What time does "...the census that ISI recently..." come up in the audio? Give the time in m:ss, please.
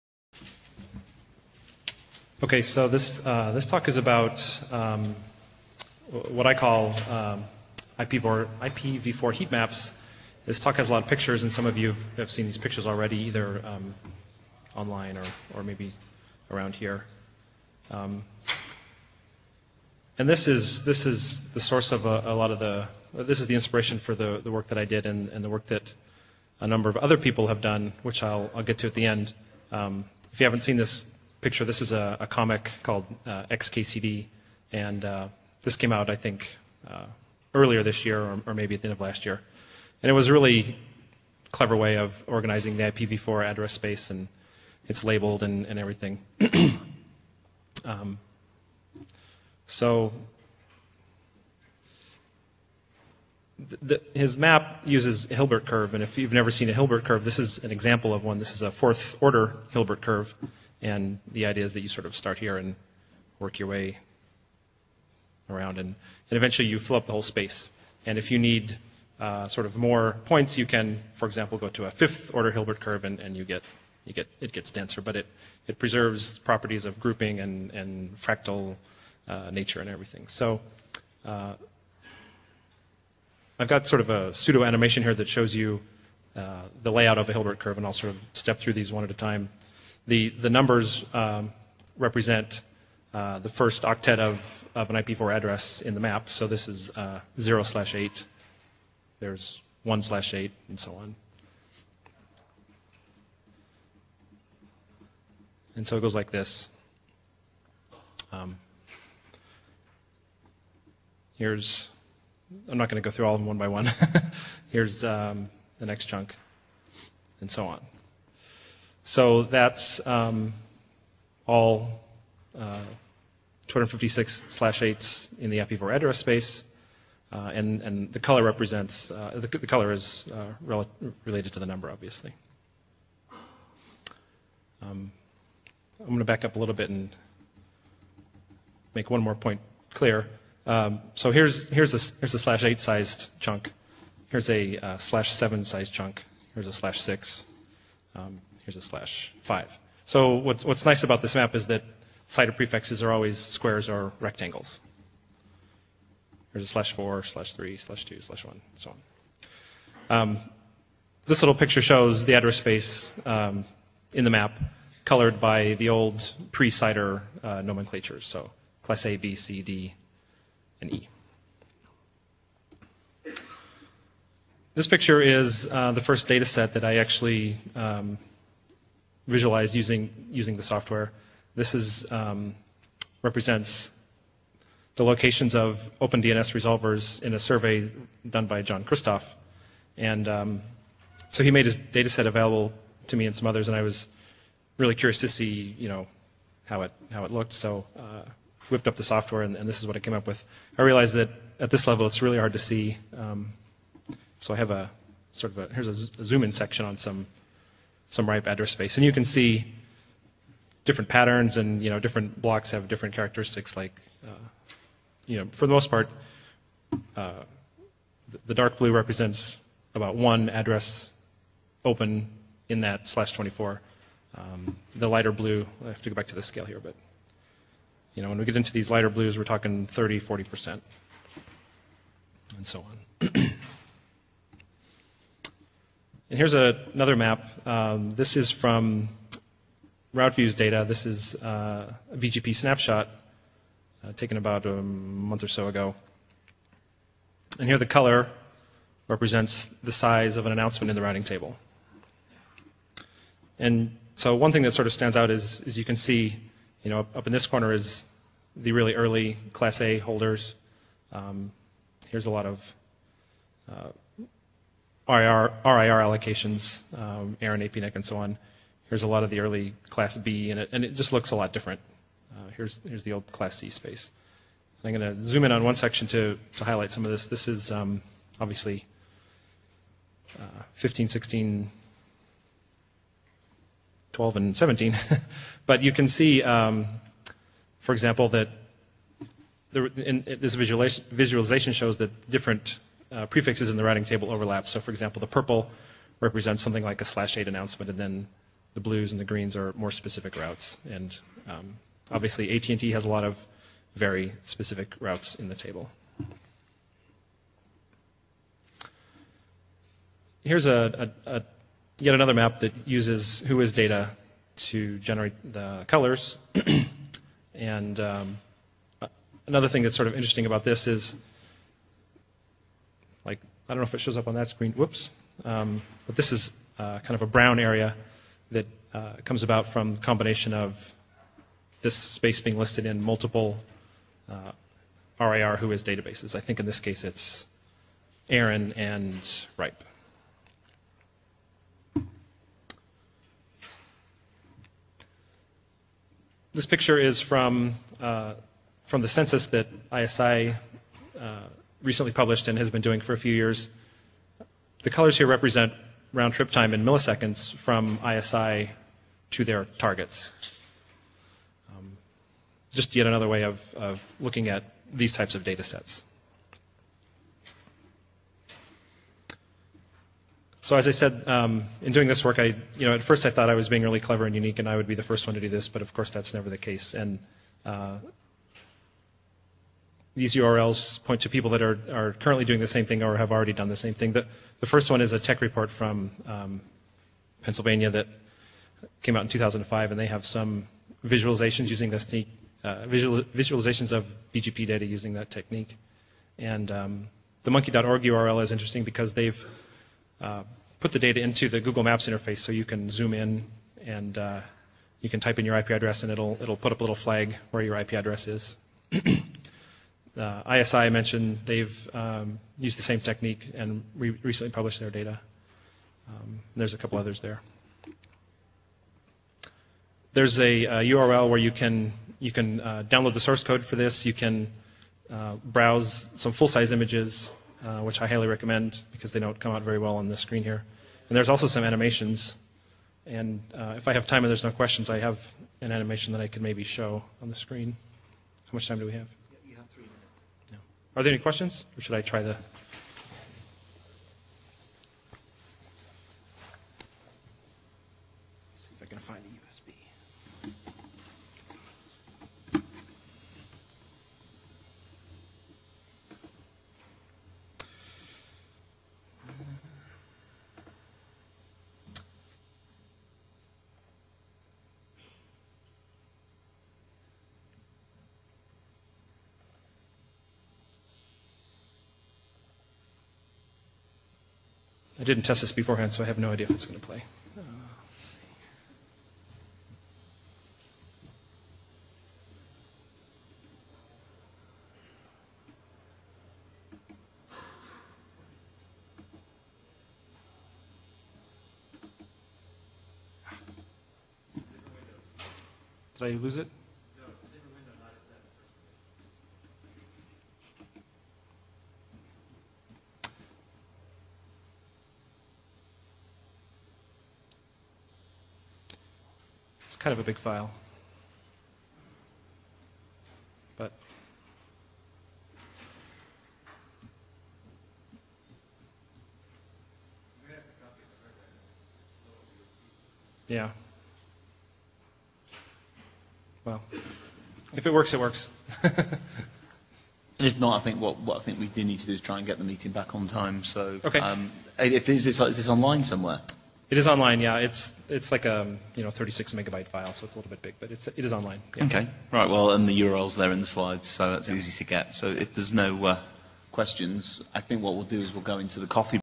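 5:49.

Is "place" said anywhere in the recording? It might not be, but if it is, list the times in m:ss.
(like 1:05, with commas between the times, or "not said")
not said.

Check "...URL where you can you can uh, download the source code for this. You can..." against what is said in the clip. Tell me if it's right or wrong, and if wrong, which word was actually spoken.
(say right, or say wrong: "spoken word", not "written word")
right.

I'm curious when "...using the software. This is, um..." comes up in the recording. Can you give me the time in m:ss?
3:00.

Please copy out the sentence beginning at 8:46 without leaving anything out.
Well, if it works, it works.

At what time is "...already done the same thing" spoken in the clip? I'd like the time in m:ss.
6:23.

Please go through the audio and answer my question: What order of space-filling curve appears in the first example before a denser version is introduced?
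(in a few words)
fourth order.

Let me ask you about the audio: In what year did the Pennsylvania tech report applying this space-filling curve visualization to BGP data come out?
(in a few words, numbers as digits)
2005.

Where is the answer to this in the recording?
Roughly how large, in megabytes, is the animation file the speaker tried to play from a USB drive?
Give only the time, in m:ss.
8:58.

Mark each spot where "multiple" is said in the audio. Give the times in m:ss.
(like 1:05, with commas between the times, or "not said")
5:33.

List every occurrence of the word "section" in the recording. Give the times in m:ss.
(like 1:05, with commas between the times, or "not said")
3:26, 4:35.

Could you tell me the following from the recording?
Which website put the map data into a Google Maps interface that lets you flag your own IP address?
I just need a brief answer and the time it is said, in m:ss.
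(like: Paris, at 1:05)
monkey.org, at 6:37.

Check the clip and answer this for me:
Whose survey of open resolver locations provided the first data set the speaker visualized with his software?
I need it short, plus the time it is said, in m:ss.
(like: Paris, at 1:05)
John Kristoff, at 3:08.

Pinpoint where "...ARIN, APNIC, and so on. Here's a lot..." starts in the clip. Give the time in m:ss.
4:27.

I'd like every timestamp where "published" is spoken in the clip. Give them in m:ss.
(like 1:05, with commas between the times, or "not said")
5:52, 6:54.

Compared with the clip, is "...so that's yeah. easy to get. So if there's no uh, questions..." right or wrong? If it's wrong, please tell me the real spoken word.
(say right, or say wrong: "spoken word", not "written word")
right.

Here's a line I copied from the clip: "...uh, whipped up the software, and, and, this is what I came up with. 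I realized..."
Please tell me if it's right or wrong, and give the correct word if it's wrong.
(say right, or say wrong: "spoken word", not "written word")
right.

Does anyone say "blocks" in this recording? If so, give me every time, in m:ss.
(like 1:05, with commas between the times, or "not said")
3:32.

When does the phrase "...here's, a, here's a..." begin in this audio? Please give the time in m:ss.
2:21.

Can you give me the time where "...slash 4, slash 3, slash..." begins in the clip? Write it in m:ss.
2:36.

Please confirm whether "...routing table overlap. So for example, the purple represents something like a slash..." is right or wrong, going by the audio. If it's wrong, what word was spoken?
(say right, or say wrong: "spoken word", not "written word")
right.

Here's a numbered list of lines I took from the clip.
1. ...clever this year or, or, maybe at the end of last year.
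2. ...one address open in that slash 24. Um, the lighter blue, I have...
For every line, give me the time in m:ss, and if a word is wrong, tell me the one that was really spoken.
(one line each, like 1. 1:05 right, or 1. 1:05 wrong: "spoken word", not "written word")
1. 0:37 wrong: "earlier", not "clever"
2. 3:40 right.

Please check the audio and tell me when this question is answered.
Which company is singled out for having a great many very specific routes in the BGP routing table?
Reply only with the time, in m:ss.
5:02.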